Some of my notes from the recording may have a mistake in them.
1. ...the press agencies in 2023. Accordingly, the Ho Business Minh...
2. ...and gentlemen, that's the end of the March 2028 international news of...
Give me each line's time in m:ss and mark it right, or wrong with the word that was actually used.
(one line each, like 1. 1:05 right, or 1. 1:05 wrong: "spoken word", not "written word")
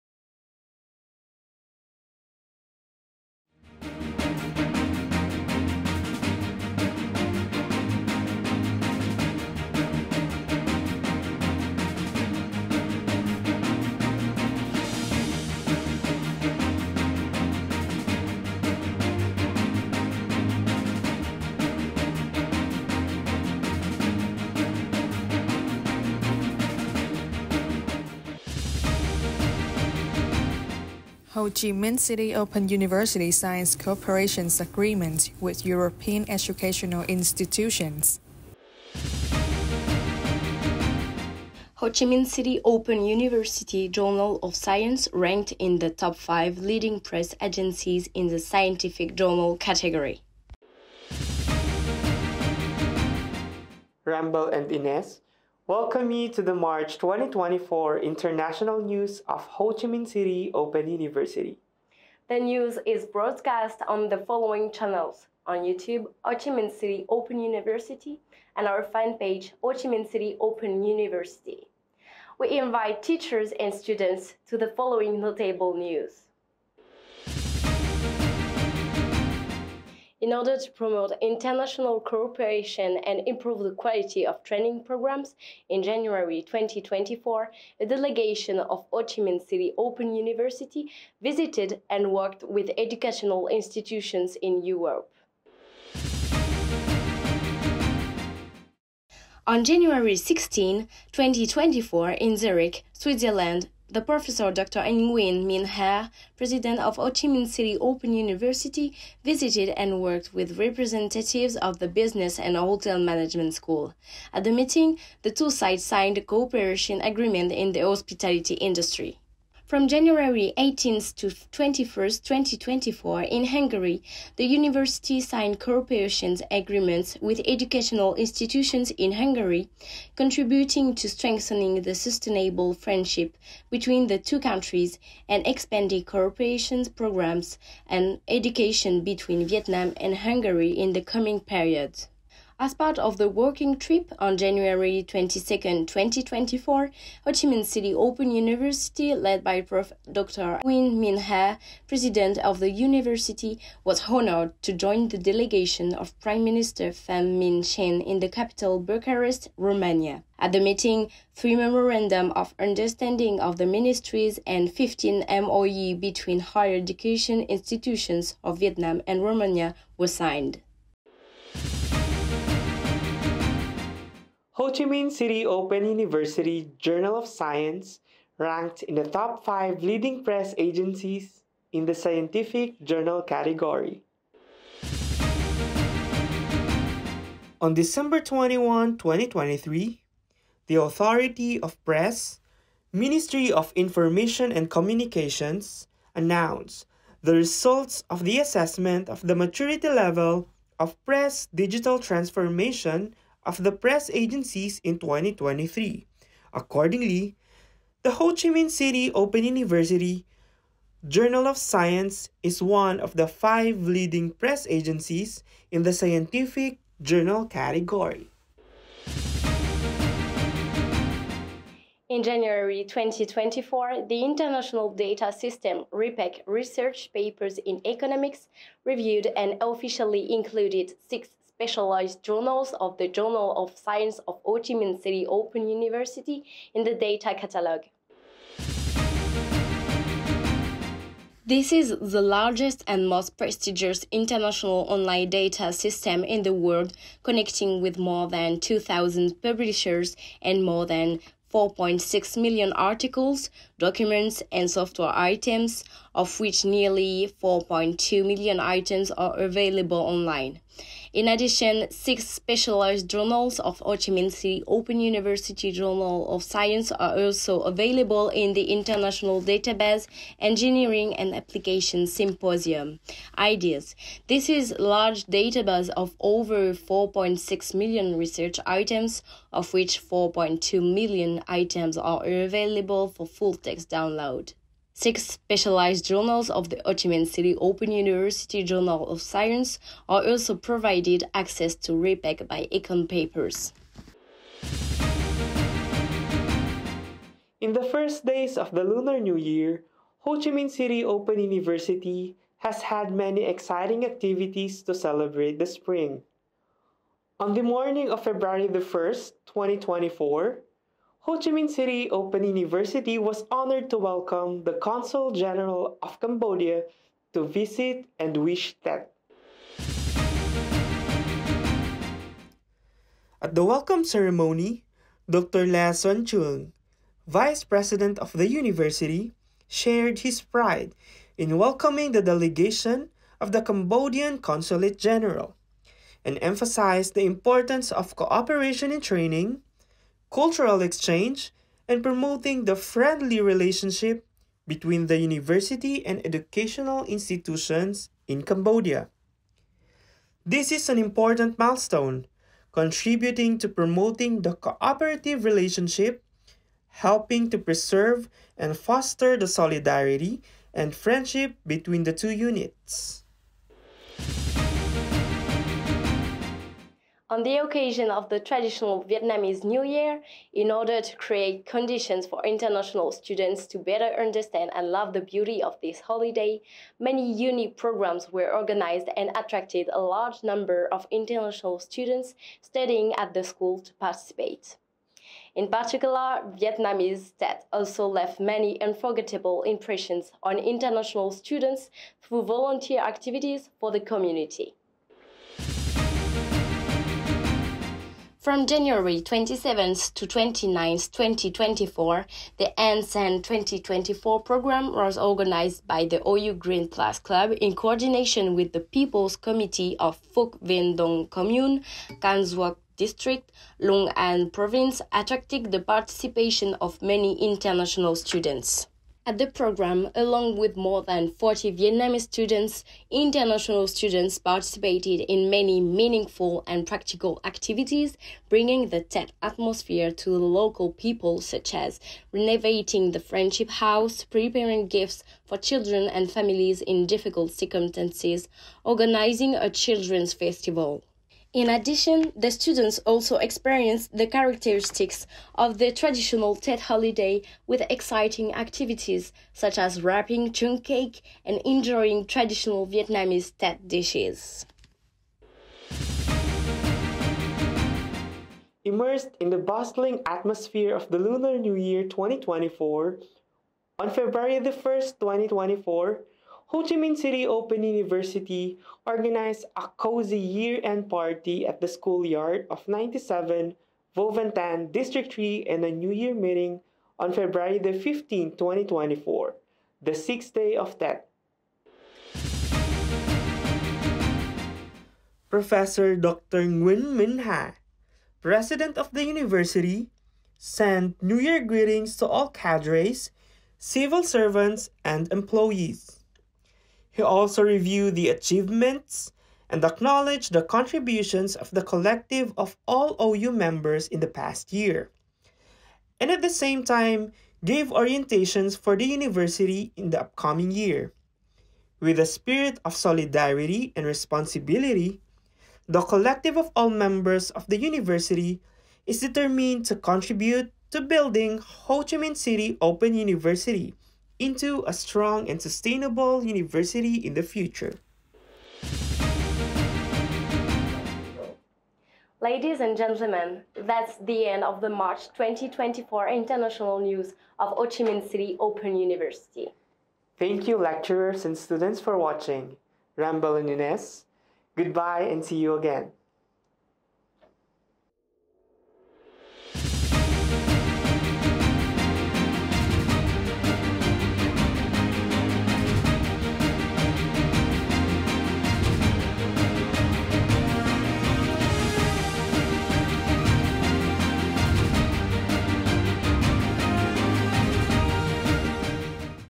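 1. 3:23 wrong: "Chi", not "Business"
2. 8:52 wrong: "2024", not "2028".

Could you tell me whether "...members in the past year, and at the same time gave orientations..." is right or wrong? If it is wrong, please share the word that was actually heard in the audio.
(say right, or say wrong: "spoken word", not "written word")
right.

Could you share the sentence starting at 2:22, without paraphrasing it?
As part of the working trip on January 22, 2024, Ho Chi Minh City Open University, led by Prof.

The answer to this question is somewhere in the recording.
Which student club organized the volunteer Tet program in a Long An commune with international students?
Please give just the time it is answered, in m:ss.
6:46.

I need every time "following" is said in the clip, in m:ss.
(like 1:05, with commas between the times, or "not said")
1:04, 1:14.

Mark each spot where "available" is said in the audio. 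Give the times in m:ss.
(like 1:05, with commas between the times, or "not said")
4:19, 4:27, 4:42.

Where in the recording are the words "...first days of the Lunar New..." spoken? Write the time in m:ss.
4:57.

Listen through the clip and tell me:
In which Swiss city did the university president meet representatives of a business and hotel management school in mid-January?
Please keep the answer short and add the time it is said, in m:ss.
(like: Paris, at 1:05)
Zurich, at 1:42.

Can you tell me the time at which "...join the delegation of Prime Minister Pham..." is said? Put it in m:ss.
2:34.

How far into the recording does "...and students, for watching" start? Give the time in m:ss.
9:01.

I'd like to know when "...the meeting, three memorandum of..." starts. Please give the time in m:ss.
2:40.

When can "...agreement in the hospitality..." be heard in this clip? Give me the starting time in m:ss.
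1:57.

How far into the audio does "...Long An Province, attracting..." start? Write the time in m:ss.
6:53.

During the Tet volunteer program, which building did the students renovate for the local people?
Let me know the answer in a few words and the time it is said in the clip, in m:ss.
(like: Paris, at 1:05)
Friendship House, at 7:13.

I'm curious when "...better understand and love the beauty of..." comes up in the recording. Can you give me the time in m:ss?
6:13.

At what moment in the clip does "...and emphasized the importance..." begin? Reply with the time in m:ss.
5:36.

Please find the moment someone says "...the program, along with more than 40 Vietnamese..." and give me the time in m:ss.
6:59.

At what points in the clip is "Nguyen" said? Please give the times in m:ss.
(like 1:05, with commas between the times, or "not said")
1:44, 2:30, 8:06.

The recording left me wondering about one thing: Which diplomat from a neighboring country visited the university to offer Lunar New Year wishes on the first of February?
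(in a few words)
Consul General of Cambodia.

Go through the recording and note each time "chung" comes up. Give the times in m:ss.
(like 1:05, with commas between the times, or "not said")
5:26, 7:30.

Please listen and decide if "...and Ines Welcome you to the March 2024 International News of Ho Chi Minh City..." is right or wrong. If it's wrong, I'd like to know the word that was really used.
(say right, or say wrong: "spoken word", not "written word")
right.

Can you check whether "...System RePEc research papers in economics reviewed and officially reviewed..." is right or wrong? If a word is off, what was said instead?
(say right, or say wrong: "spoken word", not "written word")
wrong: "included", not "reviewed".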